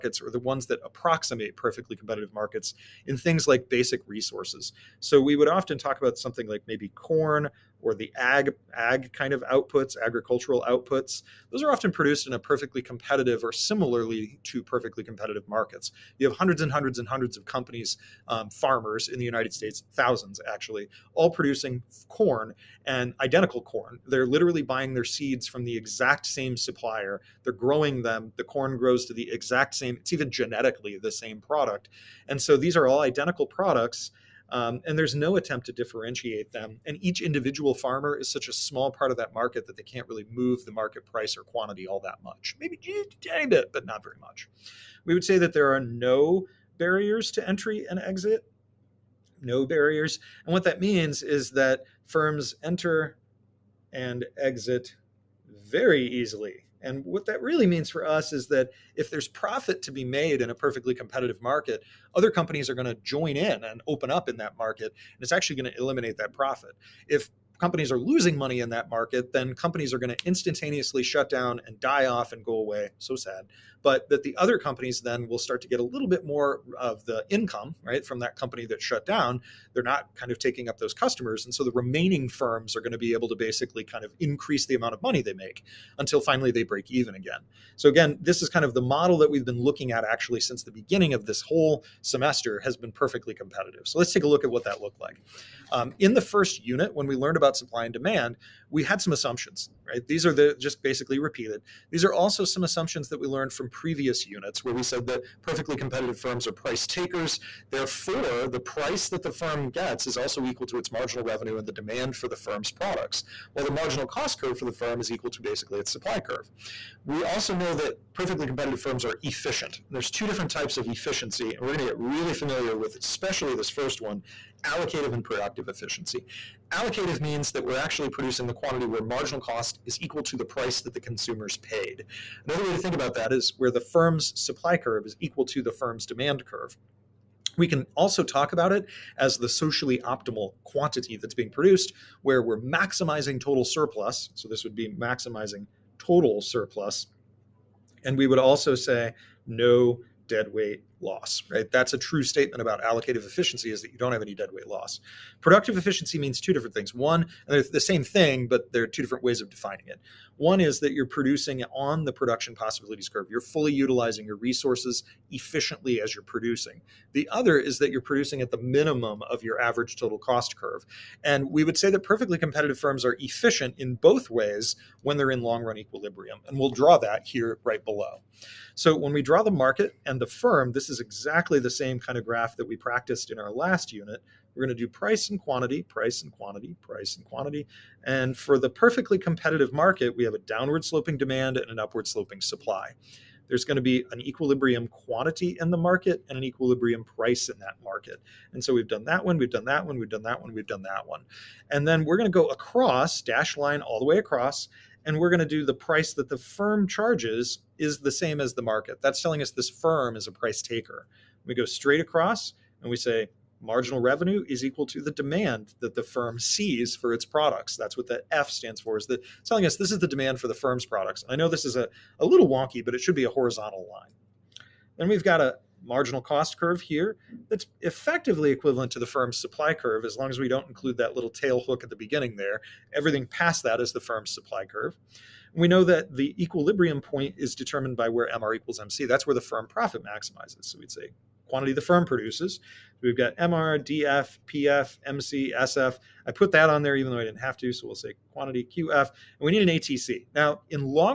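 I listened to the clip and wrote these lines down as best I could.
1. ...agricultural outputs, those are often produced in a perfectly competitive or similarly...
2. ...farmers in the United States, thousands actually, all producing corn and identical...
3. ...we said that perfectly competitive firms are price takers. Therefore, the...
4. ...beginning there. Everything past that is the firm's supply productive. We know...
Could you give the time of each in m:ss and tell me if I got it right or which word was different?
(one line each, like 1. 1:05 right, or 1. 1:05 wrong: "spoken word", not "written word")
1. 0:10 right
2. 0:18 right
3. 1:44 right
4. 3:51 wrong: "curve", not "productive".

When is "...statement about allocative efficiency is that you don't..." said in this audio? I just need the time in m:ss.
2:32.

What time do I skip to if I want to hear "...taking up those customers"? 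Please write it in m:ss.
1:20.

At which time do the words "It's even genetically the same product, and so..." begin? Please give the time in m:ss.
0:29.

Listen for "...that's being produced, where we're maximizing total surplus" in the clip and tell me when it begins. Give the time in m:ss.
2:21.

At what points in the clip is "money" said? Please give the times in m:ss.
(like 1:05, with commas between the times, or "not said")
1:08, 1:25.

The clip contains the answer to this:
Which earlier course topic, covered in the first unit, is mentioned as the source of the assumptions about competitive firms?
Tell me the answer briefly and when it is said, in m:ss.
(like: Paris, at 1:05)
Supply and demand, at 1:37.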